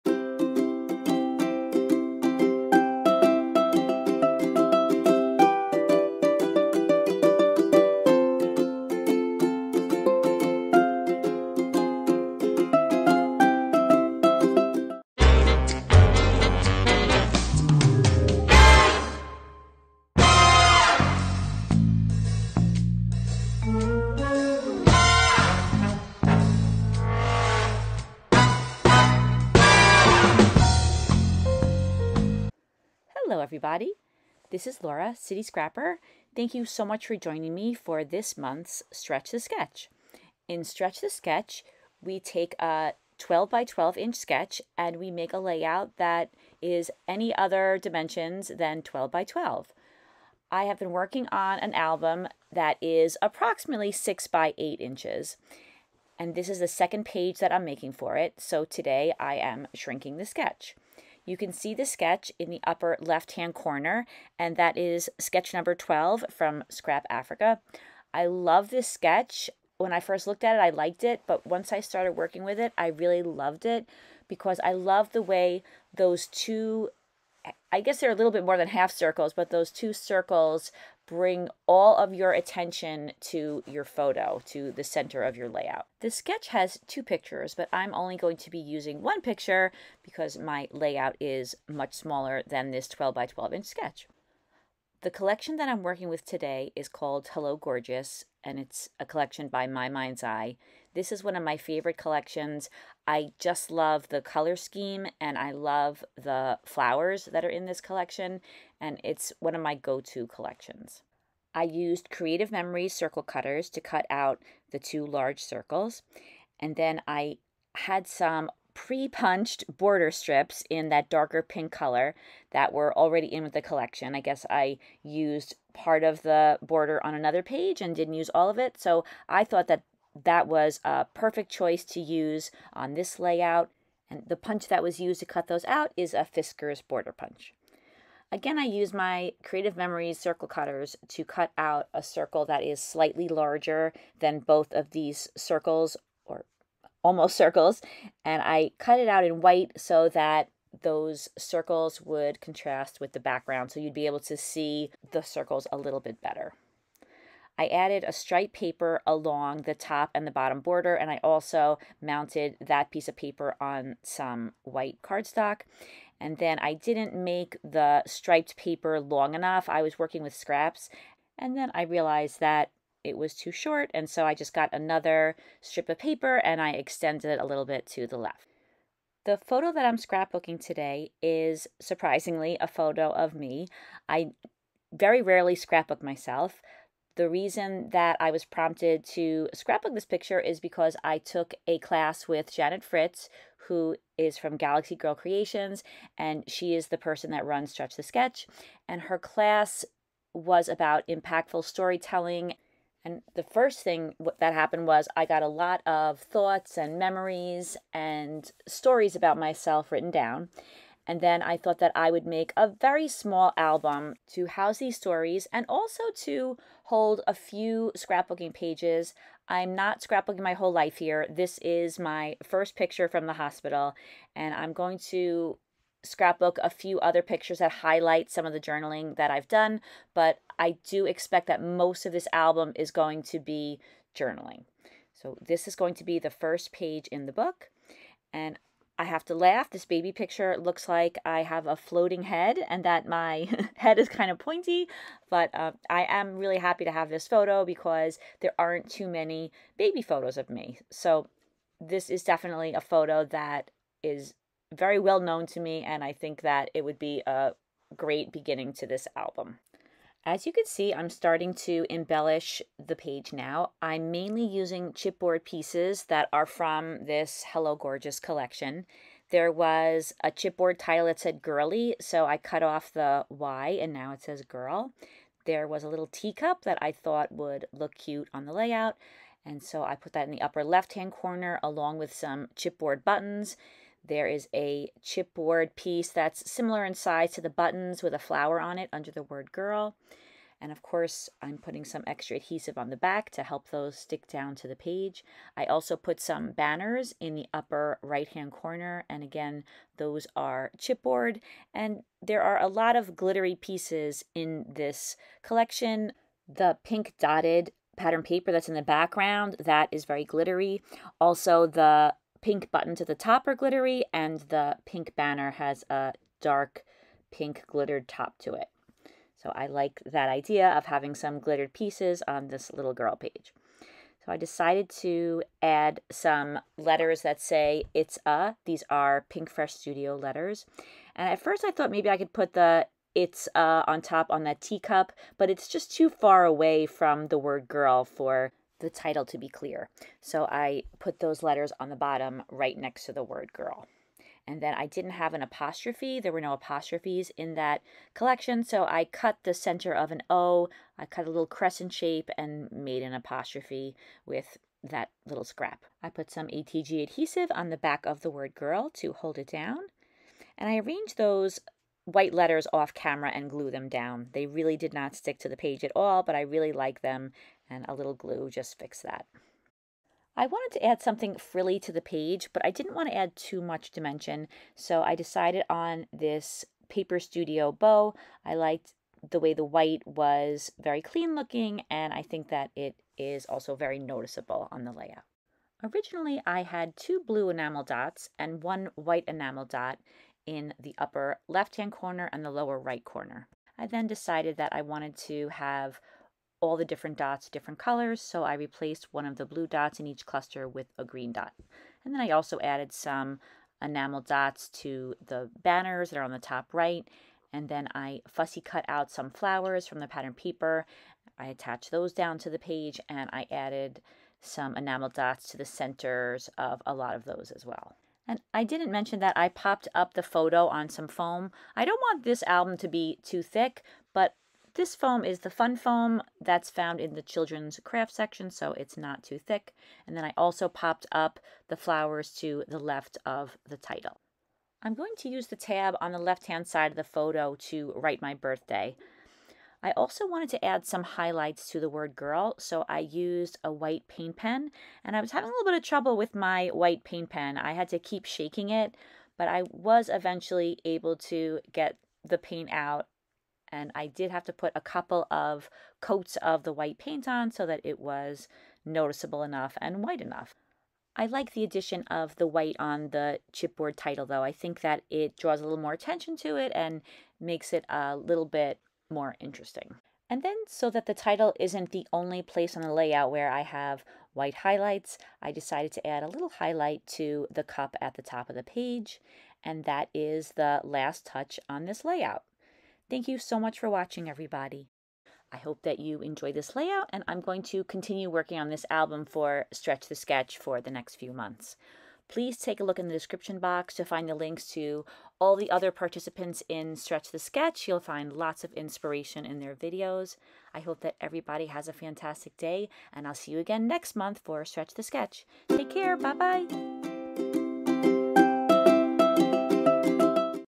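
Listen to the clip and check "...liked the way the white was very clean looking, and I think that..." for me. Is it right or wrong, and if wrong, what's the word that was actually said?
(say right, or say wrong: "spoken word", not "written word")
right.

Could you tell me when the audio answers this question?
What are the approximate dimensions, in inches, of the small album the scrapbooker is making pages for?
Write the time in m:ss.
0:53.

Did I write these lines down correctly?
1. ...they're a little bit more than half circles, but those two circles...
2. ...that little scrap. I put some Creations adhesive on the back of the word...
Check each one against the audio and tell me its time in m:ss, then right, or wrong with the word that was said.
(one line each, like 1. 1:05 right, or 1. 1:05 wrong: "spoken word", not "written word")
1. 1:17 right
2. 5:54 wrong: "ATG", not "Creations".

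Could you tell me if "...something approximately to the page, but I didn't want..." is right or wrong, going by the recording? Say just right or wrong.
wrong.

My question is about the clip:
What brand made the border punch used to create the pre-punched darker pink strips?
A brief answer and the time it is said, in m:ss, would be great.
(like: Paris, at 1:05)
Fiskars, at 2:16.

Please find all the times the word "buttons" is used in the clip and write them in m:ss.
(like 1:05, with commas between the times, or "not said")
4:43, 4:47, 5:12.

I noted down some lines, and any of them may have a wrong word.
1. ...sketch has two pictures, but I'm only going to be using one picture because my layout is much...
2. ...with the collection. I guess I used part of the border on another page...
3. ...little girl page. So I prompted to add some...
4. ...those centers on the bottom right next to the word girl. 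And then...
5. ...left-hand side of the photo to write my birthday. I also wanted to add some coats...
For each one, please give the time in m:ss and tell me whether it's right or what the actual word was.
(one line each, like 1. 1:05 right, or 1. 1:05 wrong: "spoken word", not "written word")
1. 1:26 right
2. 2:03 right
3. 5:22 wrong: "decided", not "prompted"
4. 5:41 wrong: "letters", not "centers"
5. 7:16 wrong: "highlights", not "coats".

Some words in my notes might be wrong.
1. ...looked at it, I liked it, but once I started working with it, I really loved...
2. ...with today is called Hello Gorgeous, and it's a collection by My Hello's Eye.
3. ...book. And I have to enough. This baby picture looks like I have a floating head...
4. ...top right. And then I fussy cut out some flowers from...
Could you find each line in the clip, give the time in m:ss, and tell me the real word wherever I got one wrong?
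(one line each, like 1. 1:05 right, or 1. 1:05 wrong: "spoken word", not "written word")
1. 1:10 right
2. 1:36 wrong: "Mind", not "Hello"
3. 3:57 wrong: "laugh", not "enough"
4. 6:46 right.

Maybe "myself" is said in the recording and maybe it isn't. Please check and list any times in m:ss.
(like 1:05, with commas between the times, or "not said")
3:06, 3:29.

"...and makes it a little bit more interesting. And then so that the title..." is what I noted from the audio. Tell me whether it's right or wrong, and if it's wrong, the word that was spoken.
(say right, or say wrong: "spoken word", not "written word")
right.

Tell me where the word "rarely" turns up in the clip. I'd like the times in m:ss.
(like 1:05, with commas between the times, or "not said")
3:05.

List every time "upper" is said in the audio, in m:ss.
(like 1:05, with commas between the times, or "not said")
1:02, 4:40, 4:57, 6:30.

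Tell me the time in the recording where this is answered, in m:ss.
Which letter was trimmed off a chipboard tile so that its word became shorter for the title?
4:32.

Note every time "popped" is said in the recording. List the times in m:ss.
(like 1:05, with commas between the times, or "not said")
6:59, 7:10.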